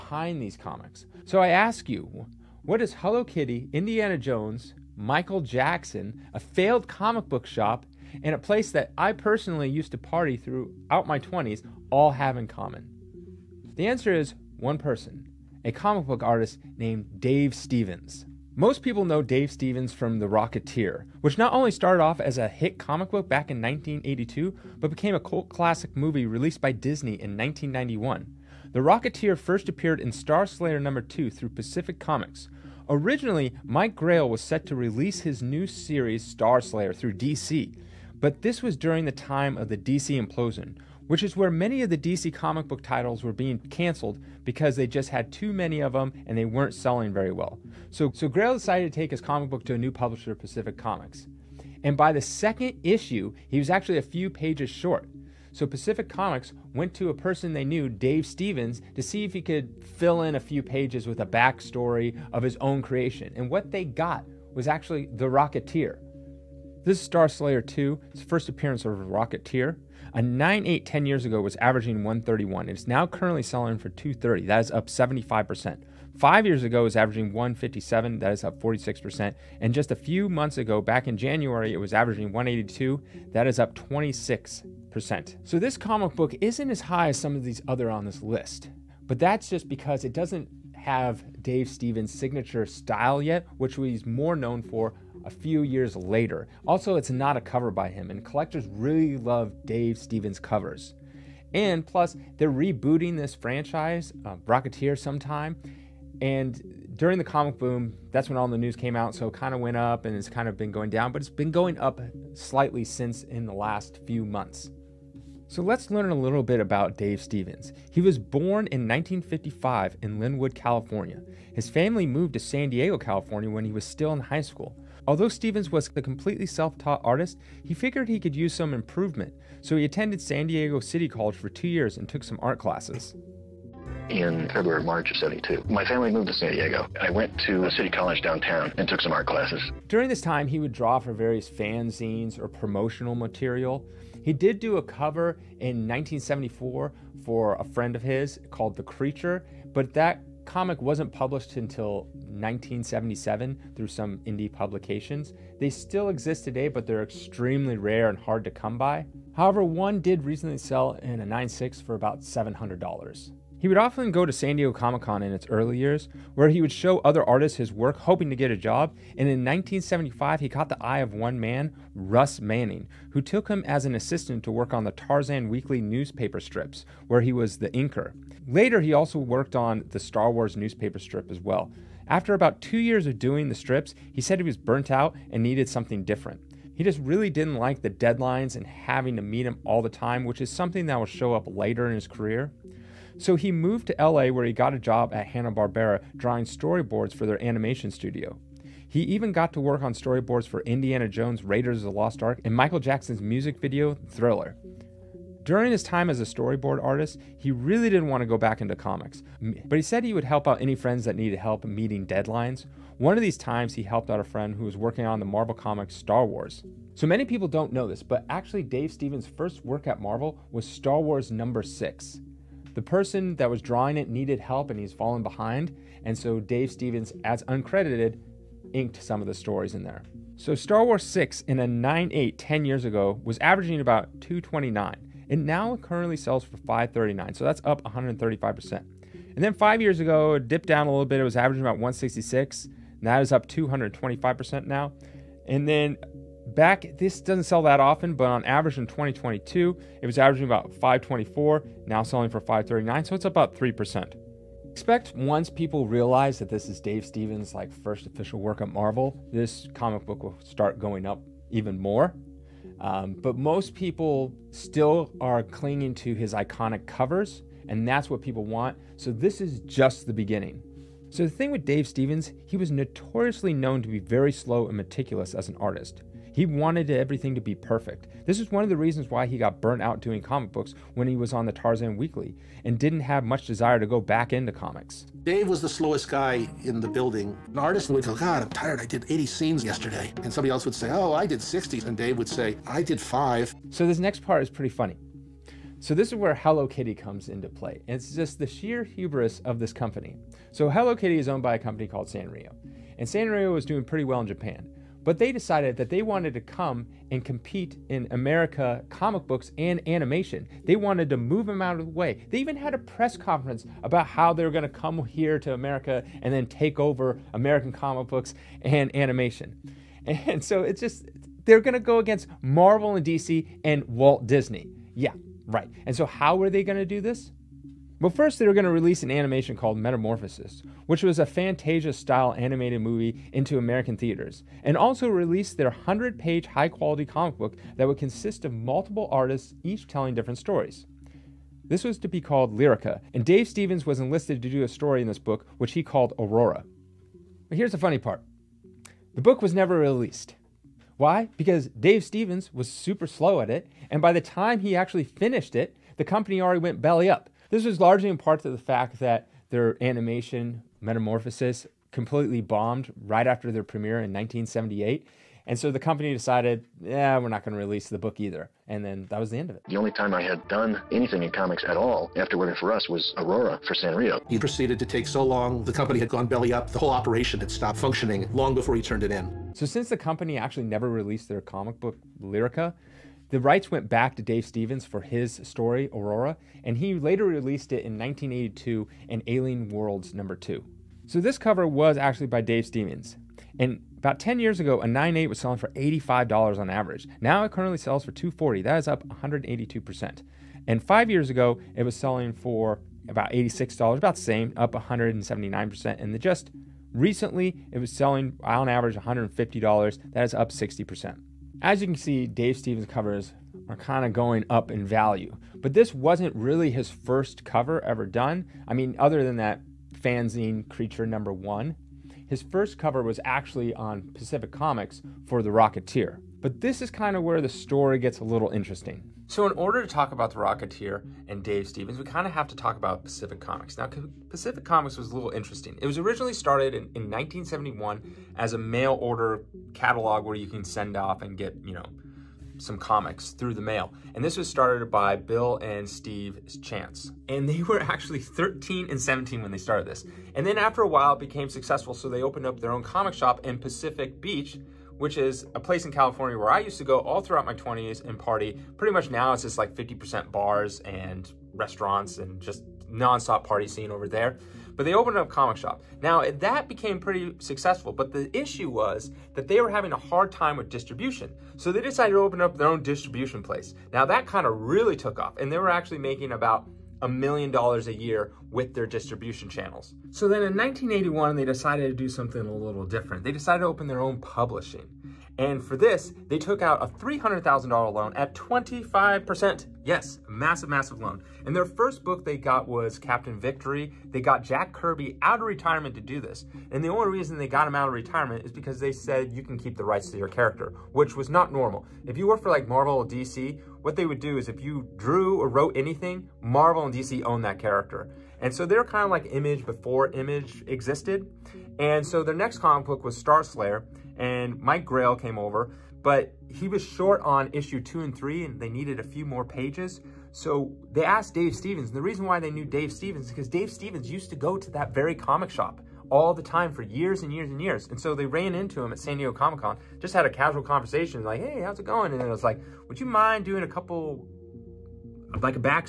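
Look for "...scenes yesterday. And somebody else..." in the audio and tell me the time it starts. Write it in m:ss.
4:49.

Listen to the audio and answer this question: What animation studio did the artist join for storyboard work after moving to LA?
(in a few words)
Hanna-Barbera.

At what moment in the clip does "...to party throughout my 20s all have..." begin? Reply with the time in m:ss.
0:09.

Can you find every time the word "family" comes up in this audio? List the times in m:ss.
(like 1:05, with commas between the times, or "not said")
2:01, 2:15.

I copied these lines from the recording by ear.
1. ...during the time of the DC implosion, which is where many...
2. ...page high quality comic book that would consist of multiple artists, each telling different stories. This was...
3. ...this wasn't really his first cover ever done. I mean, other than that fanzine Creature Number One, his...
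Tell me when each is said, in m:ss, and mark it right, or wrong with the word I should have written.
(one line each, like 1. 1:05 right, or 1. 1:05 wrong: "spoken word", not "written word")
1. 0:38 right
2. 5:36 right
3. 6:55 right.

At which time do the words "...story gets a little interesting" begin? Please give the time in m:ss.
7:07.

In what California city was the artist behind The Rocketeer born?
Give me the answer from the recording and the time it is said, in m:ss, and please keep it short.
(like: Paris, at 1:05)
Lynwood, at 2:00.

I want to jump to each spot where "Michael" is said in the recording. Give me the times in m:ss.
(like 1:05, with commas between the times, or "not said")
0:04, 3:22.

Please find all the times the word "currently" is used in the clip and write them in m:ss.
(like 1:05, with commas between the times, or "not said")
1:13, 3:55, 6:37.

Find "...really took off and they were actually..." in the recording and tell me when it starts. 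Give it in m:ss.
7:54.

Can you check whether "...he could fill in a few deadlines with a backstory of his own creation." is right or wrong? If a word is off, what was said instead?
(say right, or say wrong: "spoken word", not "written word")
wrong: "pages", not "deadlines".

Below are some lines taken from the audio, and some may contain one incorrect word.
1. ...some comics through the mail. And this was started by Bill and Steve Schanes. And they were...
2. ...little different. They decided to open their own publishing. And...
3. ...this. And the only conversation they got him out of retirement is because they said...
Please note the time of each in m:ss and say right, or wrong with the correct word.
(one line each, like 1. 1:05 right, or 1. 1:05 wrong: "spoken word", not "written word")
1. 7:22 right
2. 8:02 right
3. 8:16 wrong: "reason", not "conversation".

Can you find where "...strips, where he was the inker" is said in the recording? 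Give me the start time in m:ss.
2:56.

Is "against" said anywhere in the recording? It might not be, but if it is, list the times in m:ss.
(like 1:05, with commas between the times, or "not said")
5:21.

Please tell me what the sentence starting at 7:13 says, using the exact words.
Now, Pacific Comics was a little interesting.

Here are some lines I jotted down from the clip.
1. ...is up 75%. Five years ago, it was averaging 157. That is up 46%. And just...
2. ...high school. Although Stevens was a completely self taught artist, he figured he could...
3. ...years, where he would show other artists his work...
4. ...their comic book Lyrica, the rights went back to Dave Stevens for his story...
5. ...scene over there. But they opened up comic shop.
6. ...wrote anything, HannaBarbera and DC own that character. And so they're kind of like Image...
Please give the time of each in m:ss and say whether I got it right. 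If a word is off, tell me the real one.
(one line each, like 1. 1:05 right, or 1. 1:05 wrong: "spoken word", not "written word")
1. 1:14 right
2. 2:04 right
3. 2:45 right
4. 6:21 right
5. 7:43 right
6. 8:25 wrong: "Marvel", not "HannaBarbera".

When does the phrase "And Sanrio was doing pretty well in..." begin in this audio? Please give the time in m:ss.
5:02.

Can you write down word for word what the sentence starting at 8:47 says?
And so they ran into him at San Diego Comic Con, just had a casual conversation, like, hey, how's it going?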